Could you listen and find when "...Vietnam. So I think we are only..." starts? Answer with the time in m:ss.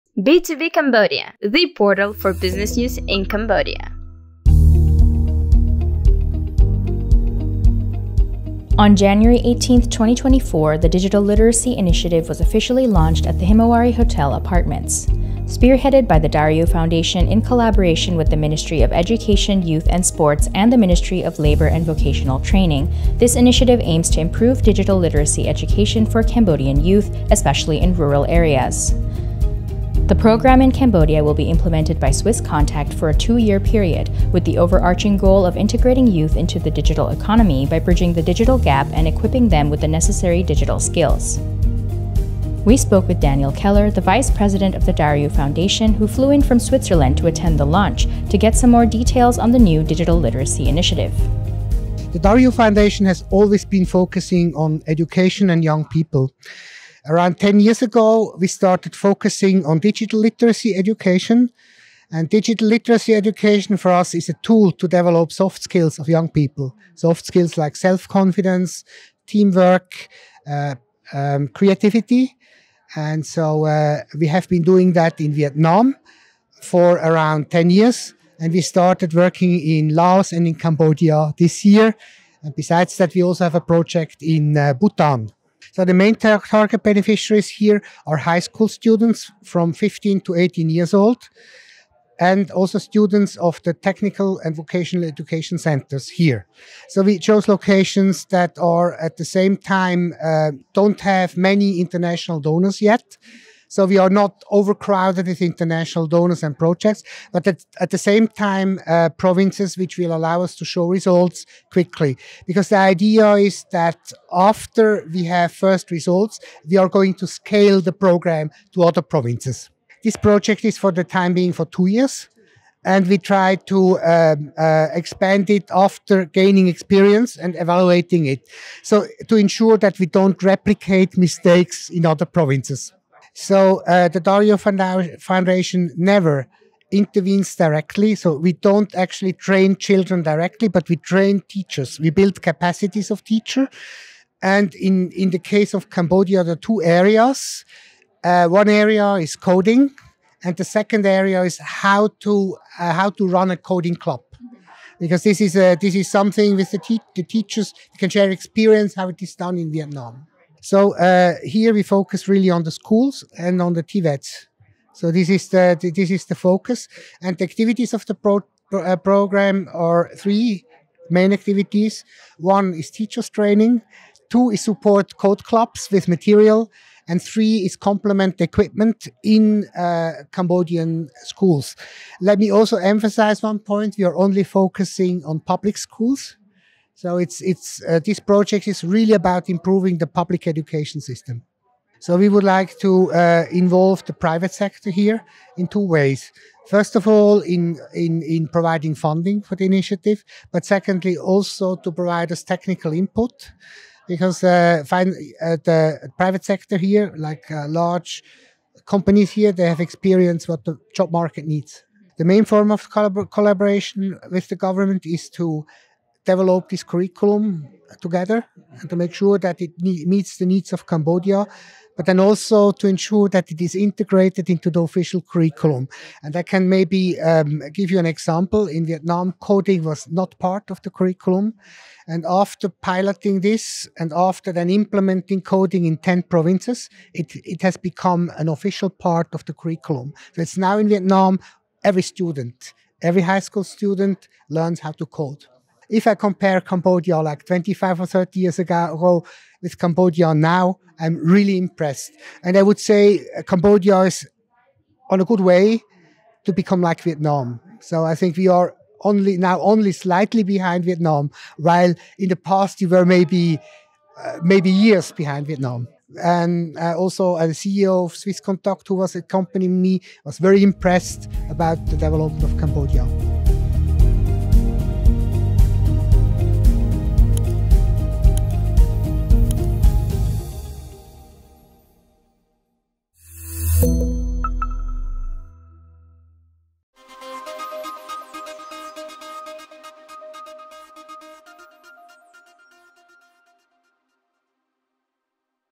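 4:17.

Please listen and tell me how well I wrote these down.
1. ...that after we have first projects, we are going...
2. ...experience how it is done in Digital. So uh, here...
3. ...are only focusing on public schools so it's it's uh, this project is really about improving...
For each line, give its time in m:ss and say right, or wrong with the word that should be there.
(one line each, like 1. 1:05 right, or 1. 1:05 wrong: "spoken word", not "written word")
1. 1:53 wrong: "results", not "projects"
2. 2:38 wrong: "Vietnam", not "Digital"
3. 3:04 right.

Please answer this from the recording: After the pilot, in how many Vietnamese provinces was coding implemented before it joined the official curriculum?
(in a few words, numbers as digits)
10.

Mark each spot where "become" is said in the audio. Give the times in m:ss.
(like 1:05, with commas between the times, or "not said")
3:57, 4:16.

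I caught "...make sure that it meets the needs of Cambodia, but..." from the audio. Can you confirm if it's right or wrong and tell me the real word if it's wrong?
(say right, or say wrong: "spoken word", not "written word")
right.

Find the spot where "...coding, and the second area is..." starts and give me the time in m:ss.
2:29.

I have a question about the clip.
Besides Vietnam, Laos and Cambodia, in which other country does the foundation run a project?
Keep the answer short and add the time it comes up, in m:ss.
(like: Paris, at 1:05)
Bhutan, at 1:24.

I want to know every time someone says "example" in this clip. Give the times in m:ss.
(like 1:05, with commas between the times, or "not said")
3:48.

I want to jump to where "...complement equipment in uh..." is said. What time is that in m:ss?
2:57.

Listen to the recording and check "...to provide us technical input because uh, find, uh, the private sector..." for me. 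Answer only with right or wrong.
right.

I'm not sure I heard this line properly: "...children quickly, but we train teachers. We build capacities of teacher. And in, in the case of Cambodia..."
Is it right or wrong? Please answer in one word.
wrong.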